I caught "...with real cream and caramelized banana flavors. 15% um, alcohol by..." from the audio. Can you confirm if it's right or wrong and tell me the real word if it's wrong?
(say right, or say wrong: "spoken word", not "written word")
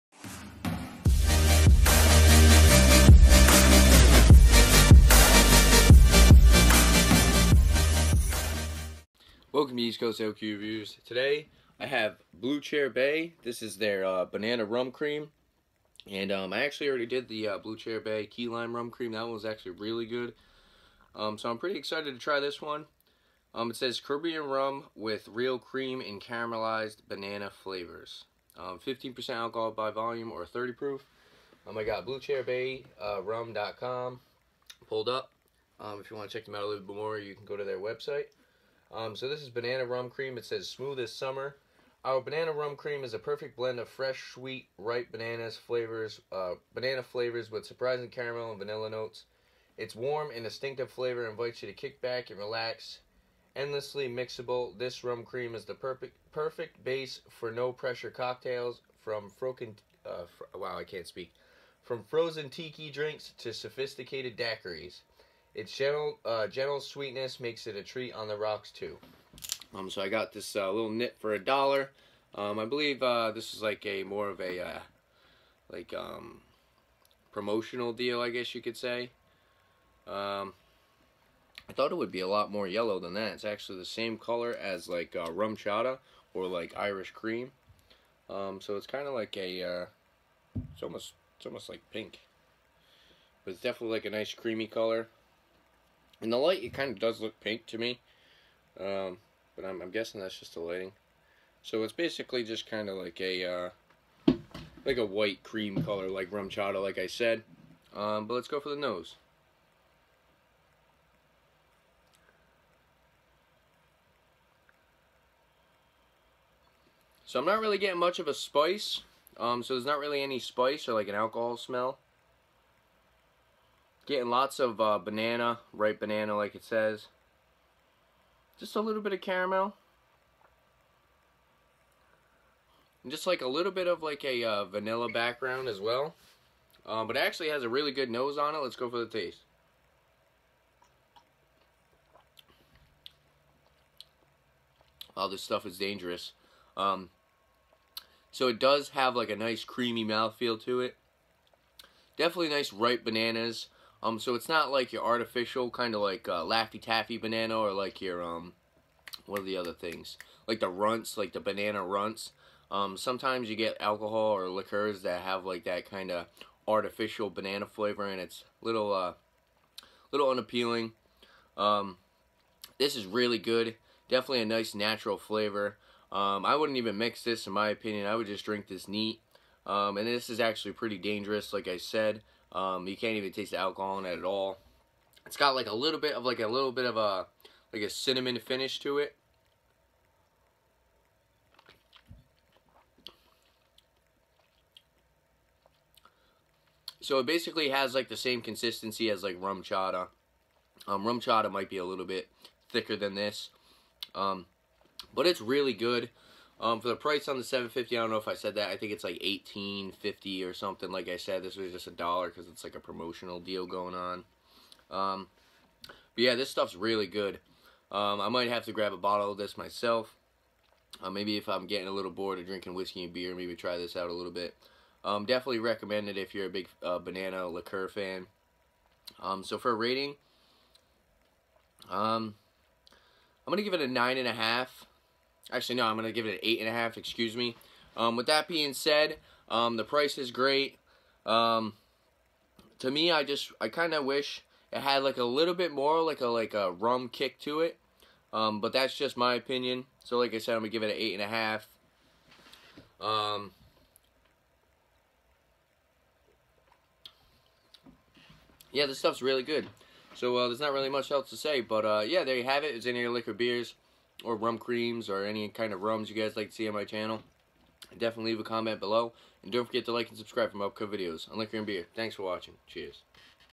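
right.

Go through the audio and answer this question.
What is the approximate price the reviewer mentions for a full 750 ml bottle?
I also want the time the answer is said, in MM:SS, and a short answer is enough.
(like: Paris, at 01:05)
$18.50, at 03:29.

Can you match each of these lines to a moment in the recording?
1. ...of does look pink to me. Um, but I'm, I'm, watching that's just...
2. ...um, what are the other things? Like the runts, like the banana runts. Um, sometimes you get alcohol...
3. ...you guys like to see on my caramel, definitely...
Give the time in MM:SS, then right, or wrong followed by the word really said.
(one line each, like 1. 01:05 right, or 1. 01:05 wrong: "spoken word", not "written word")
1. 01:36 wrong: "guessing", not "watching"
2. 02:38 right
3. 04:26 wrong: "channel", not "caramel".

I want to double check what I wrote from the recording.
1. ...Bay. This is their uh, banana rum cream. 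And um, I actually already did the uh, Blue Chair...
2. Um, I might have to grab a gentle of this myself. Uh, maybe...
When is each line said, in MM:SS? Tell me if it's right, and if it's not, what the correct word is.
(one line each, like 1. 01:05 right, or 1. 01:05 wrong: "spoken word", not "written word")
1. 00:12 right
2. 03:37 wrong: "bottle", not "gentle".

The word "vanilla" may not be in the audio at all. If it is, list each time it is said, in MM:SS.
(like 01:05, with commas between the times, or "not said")
00:48, 02:14.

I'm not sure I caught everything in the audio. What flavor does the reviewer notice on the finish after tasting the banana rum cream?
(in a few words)
cinnamon.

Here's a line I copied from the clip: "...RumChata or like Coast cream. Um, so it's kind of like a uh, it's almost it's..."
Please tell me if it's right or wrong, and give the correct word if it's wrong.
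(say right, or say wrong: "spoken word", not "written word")
wrong: "Irish", not "Coast".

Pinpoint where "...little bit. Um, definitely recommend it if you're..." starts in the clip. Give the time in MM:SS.
03:44.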